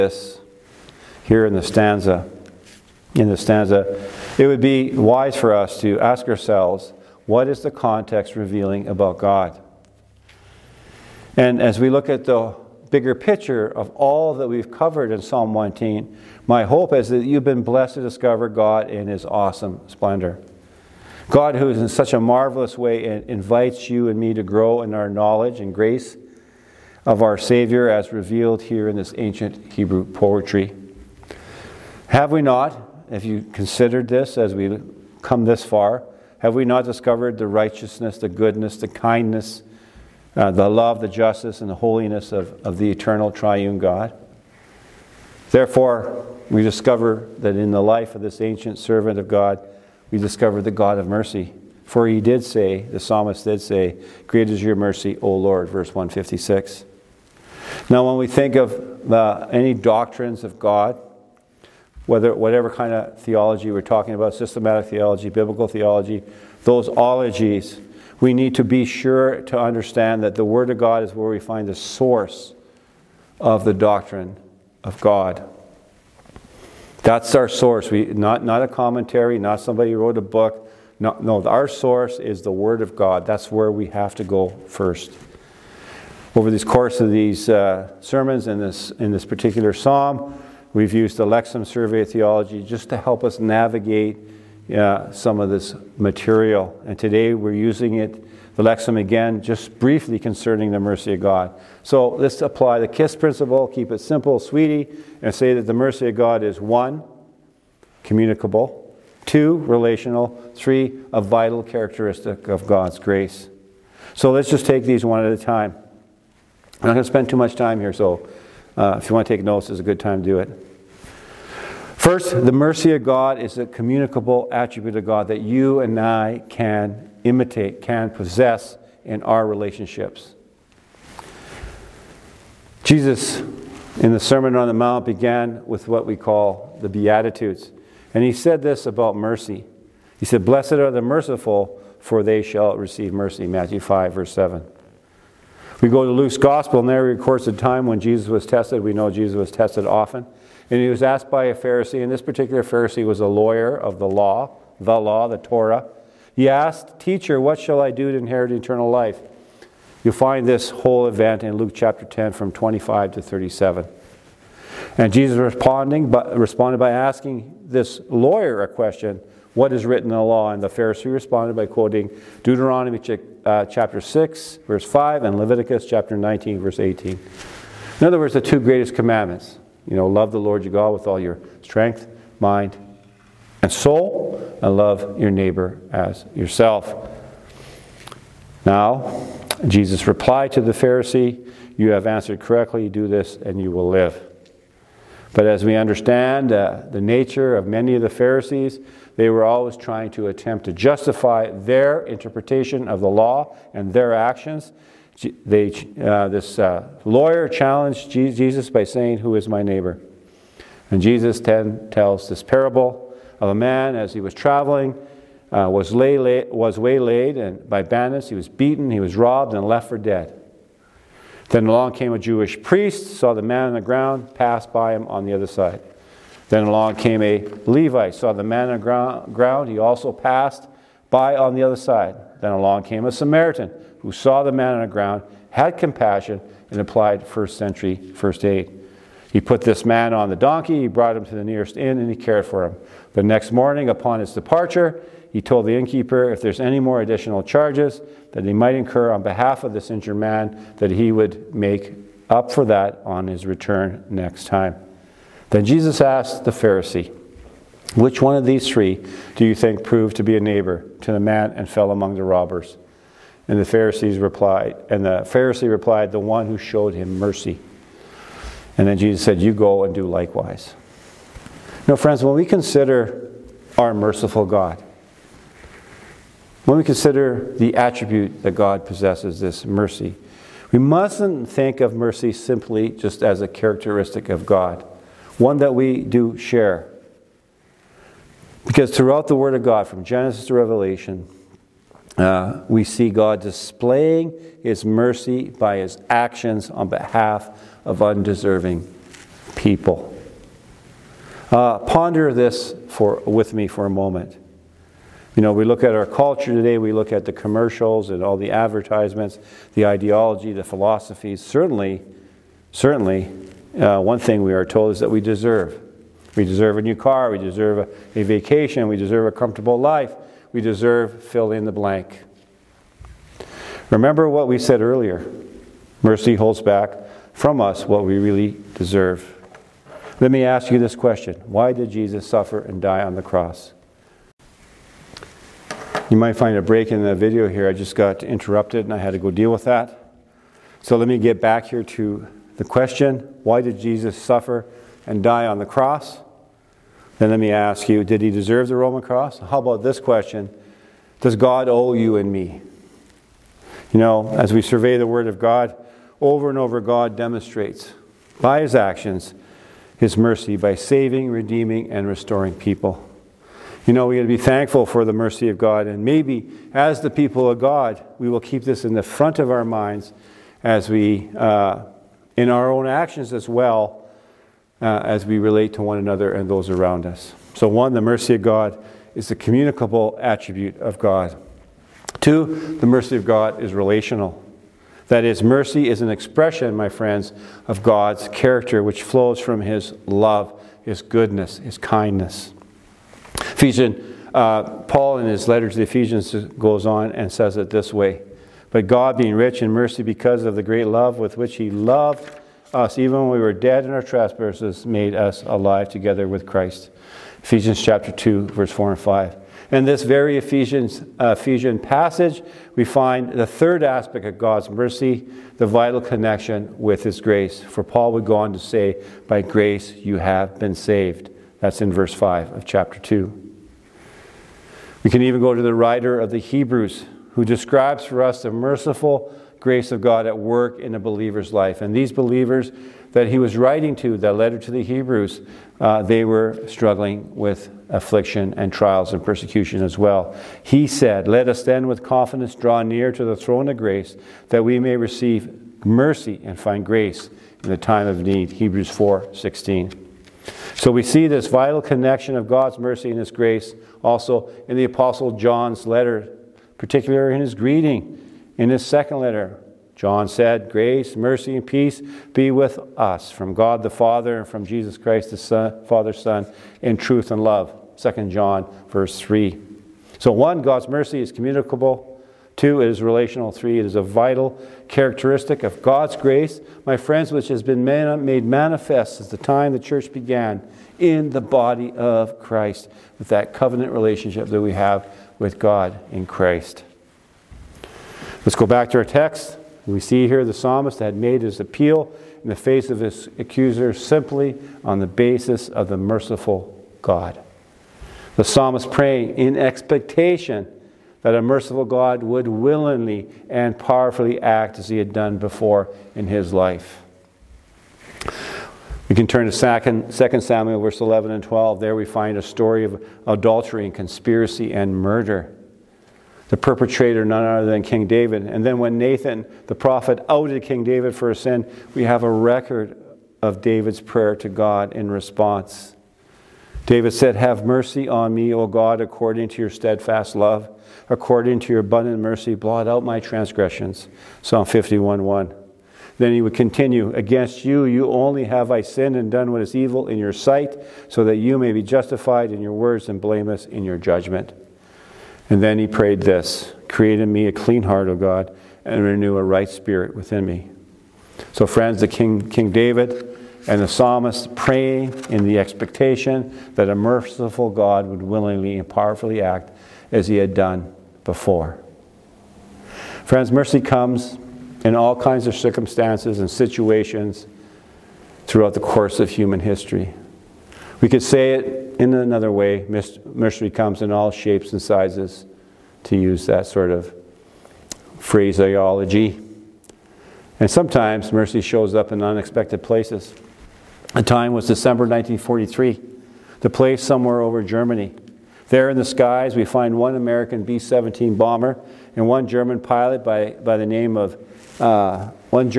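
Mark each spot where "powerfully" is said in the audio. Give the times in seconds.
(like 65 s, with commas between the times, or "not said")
503 s, 558 s.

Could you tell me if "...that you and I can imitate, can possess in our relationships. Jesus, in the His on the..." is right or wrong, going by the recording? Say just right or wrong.
wrong.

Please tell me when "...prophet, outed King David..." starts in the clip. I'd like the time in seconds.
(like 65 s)
519 s.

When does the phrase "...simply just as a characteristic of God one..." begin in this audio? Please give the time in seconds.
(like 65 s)
282 s.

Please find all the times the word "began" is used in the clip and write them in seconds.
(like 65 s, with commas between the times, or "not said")
135 s, 480 s.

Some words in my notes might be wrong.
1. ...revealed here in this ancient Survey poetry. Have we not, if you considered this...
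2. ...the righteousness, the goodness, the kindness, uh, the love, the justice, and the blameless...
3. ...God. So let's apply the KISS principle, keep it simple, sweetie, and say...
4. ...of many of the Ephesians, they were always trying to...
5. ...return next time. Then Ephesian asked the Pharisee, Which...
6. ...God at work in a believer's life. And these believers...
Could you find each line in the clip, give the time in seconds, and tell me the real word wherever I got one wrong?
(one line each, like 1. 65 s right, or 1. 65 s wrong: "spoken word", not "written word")
1. 28 s wrong: "Hebrew", not "Survey"
2. 37 s wrong: "holiness", not "blameless"
3. 101 s right
4. 197 s wrong: "Pharisees", not "Ephesians"
5. 253 s wrong: "Jesus", not "Ephesian"
6. 430 s right.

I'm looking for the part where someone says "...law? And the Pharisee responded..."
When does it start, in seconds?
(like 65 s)
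170 s.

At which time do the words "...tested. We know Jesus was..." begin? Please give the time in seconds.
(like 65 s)
148 s.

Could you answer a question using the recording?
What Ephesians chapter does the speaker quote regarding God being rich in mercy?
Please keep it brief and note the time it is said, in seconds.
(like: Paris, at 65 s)
Chapter 2, at 407 s.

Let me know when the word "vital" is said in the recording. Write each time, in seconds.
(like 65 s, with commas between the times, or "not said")
111 s, 415 s, 451 s, 474 s.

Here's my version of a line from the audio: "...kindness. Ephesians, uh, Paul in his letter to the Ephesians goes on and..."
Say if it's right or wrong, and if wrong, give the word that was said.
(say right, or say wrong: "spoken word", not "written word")
right.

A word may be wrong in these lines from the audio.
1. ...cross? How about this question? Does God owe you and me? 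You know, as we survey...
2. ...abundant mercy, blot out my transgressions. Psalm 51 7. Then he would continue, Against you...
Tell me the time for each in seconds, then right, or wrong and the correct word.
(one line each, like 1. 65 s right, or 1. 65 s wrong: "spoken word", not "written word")
1. 348 s right
2. 531 s wrong: "1", not "7".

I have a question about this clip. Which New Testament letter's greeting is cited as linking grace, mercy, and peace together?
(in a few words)
2 John.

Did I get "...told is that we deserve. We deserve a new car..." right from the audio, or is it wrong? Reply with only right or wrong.
right.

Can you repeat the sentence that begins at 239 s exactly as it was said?
He put this man on the donkey, he brought him to the nearest inn, and he cared for him.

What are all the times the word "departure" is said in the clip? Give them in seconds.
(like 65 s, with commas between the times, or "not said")
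244 s.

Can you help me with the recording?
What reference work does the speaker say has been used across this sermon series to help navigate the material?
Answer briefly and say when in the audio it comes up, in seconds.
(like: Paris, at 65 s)
Lexham Survey of Theology, at 91 s.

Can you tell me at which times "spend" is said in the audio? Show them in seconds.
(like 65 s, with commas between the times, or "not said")
117 s.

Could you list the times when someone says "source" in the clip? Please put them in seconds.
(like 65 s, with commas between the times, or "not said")
71 s, 77 s, 81 s.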